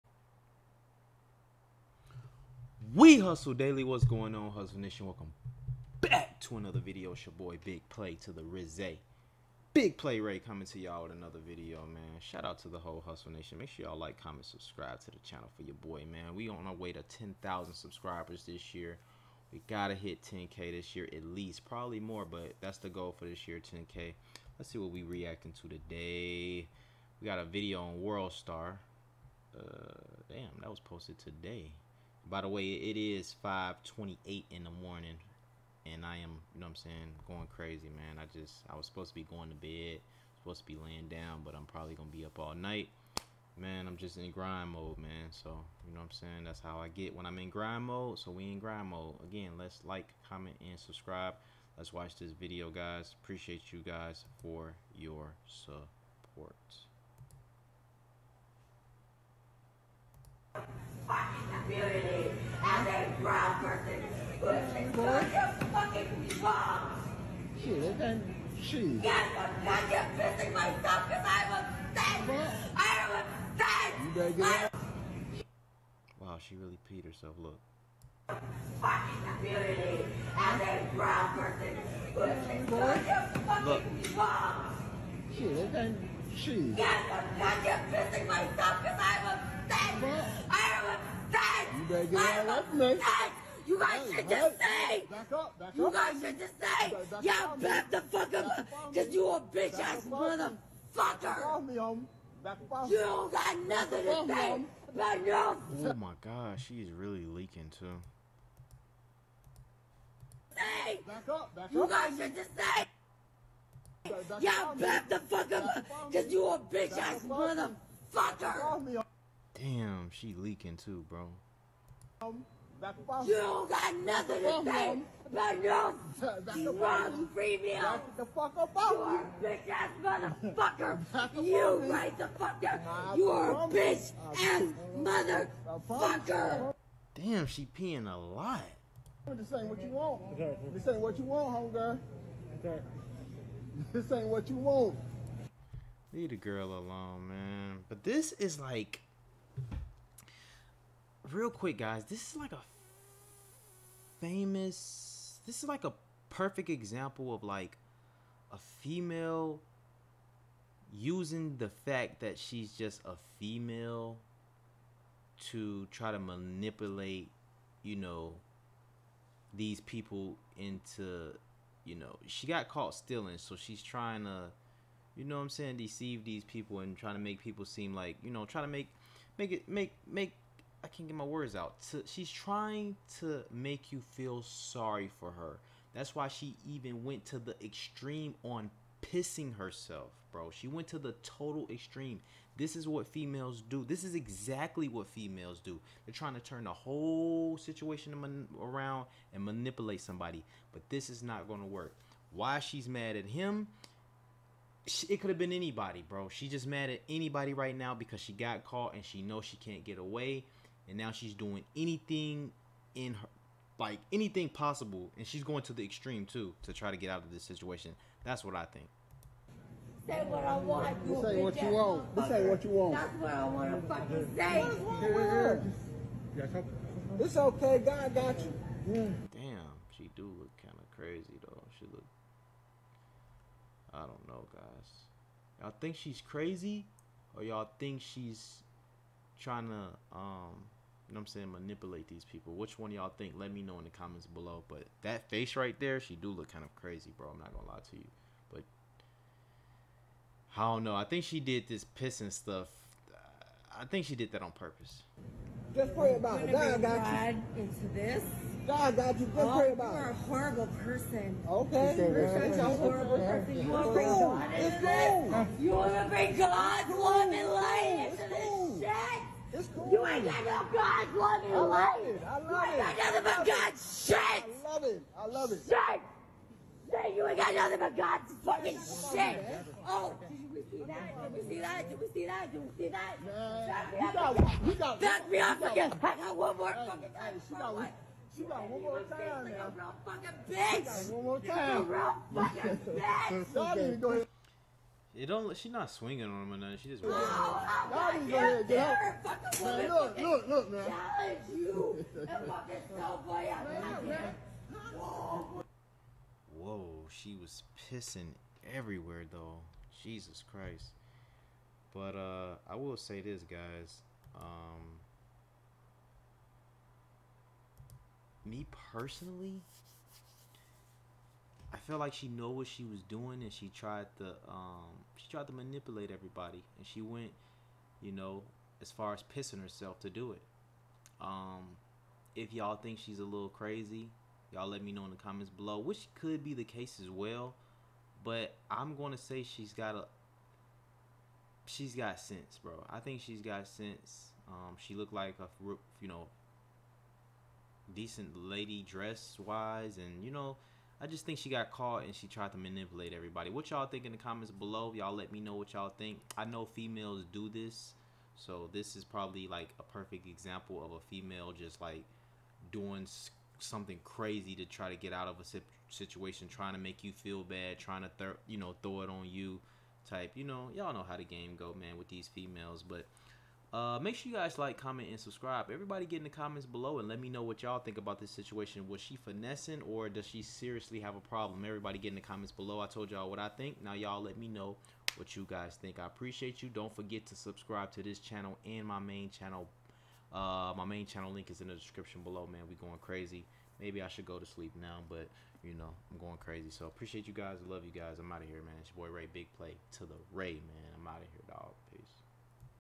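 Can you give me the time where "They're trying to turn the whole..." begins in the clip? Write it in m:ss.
3:16.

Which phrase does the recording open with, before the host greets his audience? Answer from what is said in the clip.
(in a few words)
We Hustle Daily.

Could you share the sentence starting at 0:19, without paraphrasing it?
We gotta hit 10K this year at least.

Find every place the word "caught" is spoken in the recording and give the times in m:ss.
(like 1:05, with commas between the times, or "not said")
2:52, 3:28, 5:51.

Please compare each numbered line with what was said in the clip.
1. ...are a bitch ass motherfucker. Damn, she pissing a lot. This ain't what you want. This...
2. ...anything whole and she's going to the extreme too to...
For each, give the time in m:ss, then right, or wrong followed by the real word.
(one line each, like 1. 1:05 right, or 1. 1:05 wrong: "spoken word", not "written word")
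1. 2:13 wrong: "peeing", not "pissing"
2. 3:34 wrong: "possible", not "whole".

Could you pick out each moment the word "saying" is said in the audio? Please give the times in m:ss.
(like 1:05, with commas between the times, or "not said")
0:36, 0:46, 2:55, 4:01.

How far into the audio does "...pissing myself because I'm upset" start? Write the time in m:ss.
1:10.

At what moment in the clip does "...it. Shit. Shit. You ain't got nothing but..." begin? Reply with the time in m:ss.
4:35.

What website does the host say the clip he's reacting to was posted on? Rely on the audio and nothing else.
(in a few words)
World Star.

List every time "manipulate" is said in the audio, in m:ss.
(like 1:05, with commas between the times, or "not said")
2:46, 3:19, 4:01, 5:25, 5:52.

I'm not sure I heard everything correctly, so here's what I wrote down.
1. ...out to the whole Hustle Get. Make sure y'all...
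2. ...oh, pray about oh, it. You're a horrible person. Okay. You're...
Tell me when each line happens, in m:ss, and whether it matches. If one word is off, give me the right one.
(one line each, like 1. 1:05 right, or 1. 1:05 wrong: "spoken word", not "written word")
1. 0:12 wrong: "Nation", not "Get"
2. 4:19 right.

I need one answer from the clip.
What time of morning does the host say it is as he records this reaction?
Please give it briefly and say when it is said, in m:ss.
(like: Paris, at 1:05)
5:28, at 0:33.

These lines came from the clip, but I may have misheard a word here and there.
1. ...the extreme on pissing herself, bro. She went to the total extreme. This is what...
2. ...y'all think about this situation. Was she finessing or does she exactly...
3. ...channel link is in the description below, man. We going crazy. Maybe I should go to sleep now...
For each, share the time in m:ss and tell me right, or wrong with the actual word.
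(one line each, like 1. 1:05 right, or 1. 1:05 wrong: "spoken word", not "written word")
1. 3:07 right
2. 6:17 wrong: "seriously", not "exactly"
3. 6:31 right.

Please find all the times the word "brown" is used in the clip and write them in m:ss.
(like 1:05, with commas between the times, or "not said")
1:03, 1:20.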